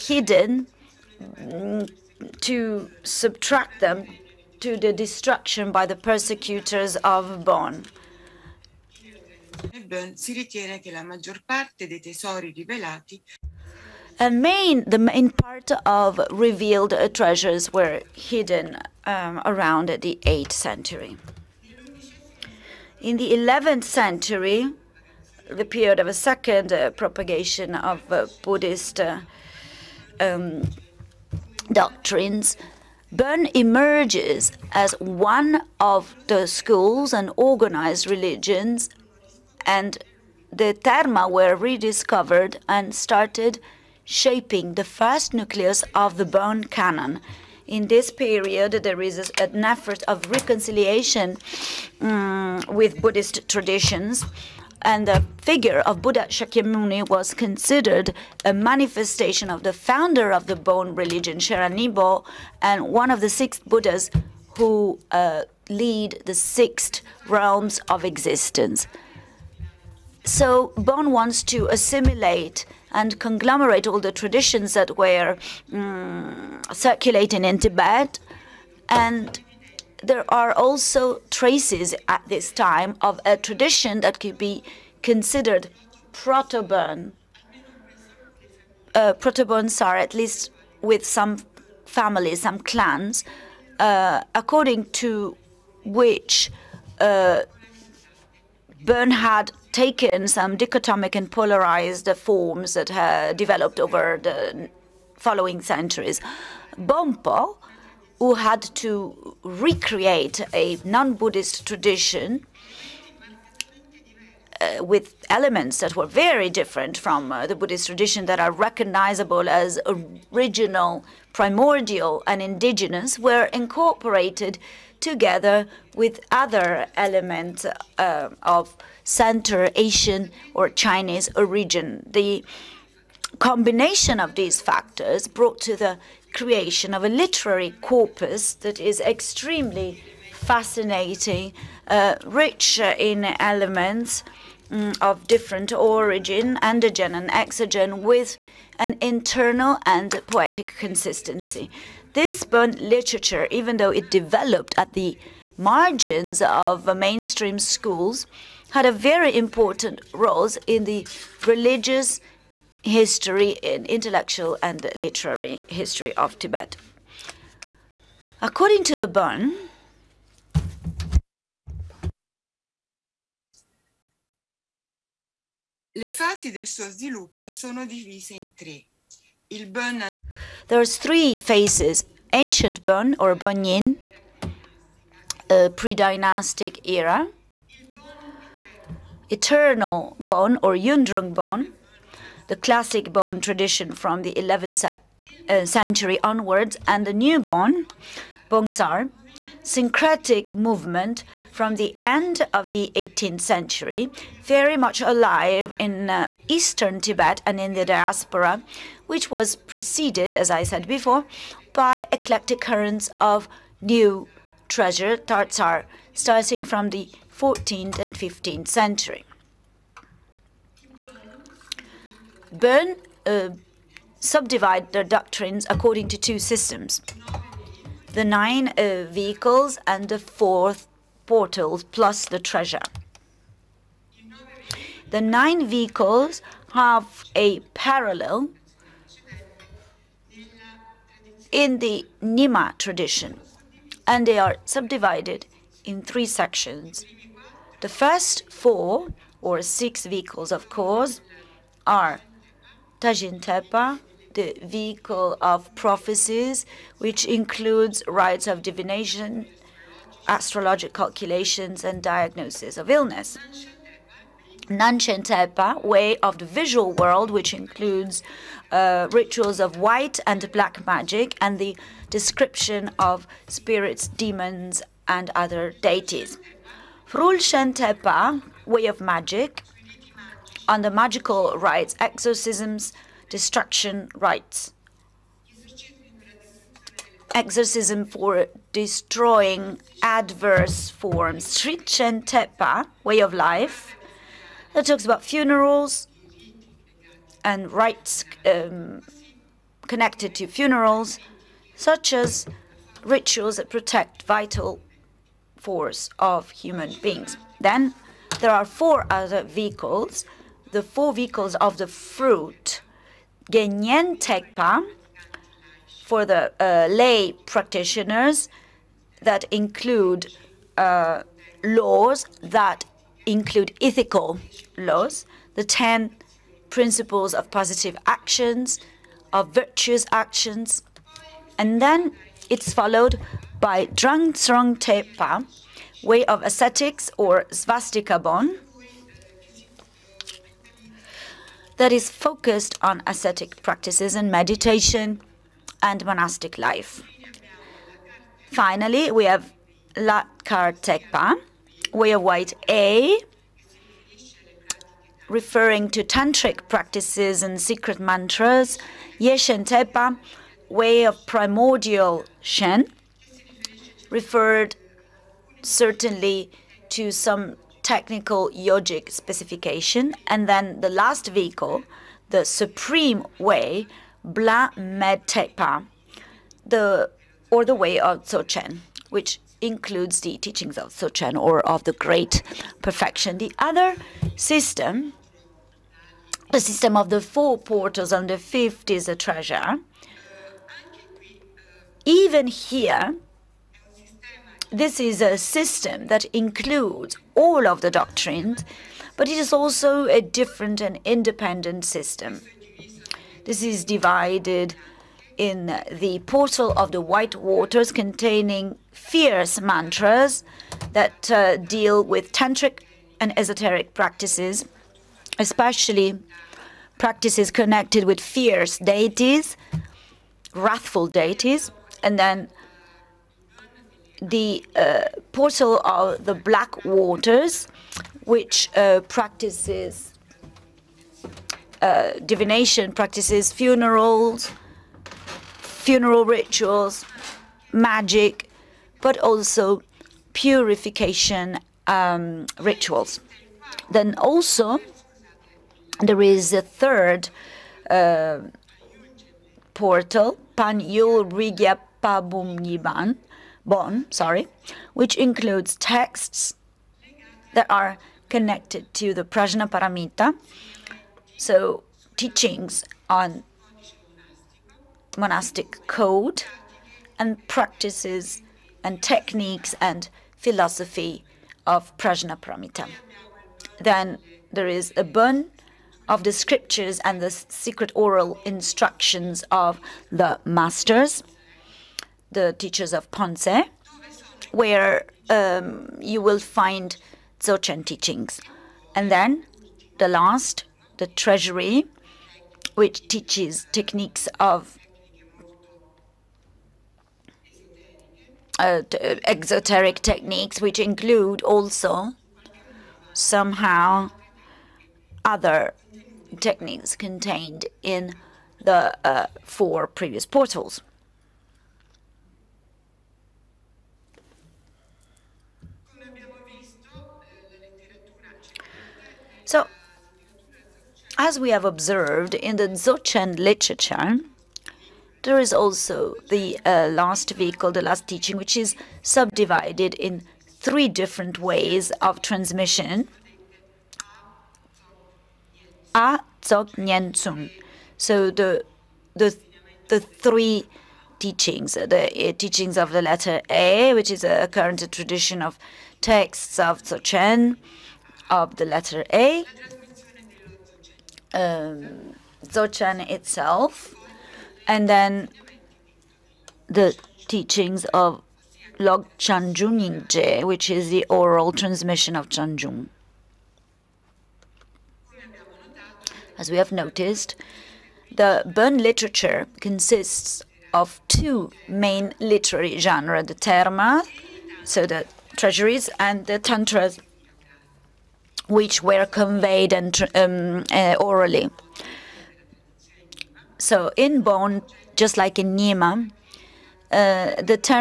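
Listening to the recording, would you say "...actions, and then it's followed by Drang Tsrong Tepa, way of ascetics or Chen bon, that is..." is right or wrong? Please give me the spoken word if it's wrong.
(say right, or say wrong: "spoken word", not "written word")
wrong: "Svastika", not "Chen".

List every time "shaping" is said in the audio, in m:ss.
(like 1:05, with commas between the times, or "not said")
0:44.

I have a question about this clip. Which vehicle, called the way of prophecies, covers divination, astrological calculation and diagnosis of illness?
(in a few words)
Tajin Tepa.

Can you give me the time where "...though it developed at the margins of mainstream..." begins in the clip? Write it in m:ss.
2:33.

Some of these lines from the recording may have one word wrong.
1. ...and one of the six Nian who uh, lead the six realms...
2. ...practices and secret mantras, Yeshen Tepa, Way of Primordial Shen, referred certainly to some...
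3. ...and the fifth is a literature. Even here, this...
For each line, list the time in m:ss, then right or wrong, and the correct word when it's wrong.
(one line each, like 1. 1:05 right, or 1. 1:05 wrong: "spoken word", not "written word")
1. 1:02 wrong: "Buddhas", not "Nian"
2. 5:56 right
3. 6:28 wrong: "treasure", not "literature".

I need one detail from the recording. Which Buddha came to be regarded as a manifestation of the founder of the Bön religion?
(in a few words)
Buddha Shakyamuni.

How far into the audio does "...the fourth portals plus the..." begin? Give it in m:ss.
3:50.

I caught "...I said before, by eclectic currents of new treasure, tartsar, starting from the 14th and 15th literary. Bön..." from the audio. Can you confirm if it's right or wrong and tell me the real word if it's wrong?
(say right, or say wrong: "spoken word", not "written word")
wrong: "century", not "literary".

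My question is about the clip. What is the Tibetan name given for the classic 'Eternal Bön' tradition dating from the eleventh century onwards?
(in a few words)
Yundrung Bon.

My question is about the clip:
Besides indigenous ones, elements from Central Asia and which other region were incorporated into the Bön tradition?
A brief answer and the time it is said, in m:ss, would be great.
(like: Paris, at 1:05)
Chinese, at 2:10.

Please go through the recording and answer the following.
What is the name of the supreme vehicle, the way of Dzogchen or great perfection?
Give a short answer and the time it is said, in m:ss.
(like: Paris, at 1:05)
Bla Med Tepa, at 6:14.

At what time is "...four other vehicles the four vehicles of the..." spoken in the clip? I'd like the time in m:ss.
5:08.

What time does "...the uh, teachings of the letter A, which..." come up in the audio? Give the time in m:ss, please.
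9:01.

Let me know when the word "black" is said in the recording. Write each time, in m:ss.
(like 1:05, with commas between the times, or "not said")
4:30, 7:06.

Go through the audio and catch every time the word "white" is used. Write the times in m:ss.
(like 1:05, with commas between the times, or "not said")
4:29, 5:52, 6:47.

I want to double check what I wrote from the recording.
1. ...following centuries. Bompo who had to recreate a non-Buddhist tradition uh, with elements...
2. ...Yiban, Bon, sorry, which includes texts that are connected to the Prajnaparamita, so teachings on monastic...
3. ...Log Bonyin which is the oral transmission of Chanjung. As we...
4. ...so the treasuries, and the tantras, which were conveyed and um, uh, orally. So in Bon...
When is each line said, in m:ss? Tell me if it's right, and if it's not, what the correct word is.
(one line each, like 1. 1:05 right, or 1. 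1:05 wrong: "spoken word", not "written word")
1. 1:45 right
2. 7:32 right
3. 9:18 wrong: "Chanjun", not "Bonyin"
4. 9:34 right.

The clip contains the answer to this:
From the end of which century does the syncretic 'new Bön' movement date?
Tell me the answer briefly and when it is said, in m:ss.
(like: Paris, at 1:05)
18th century, at 3:22.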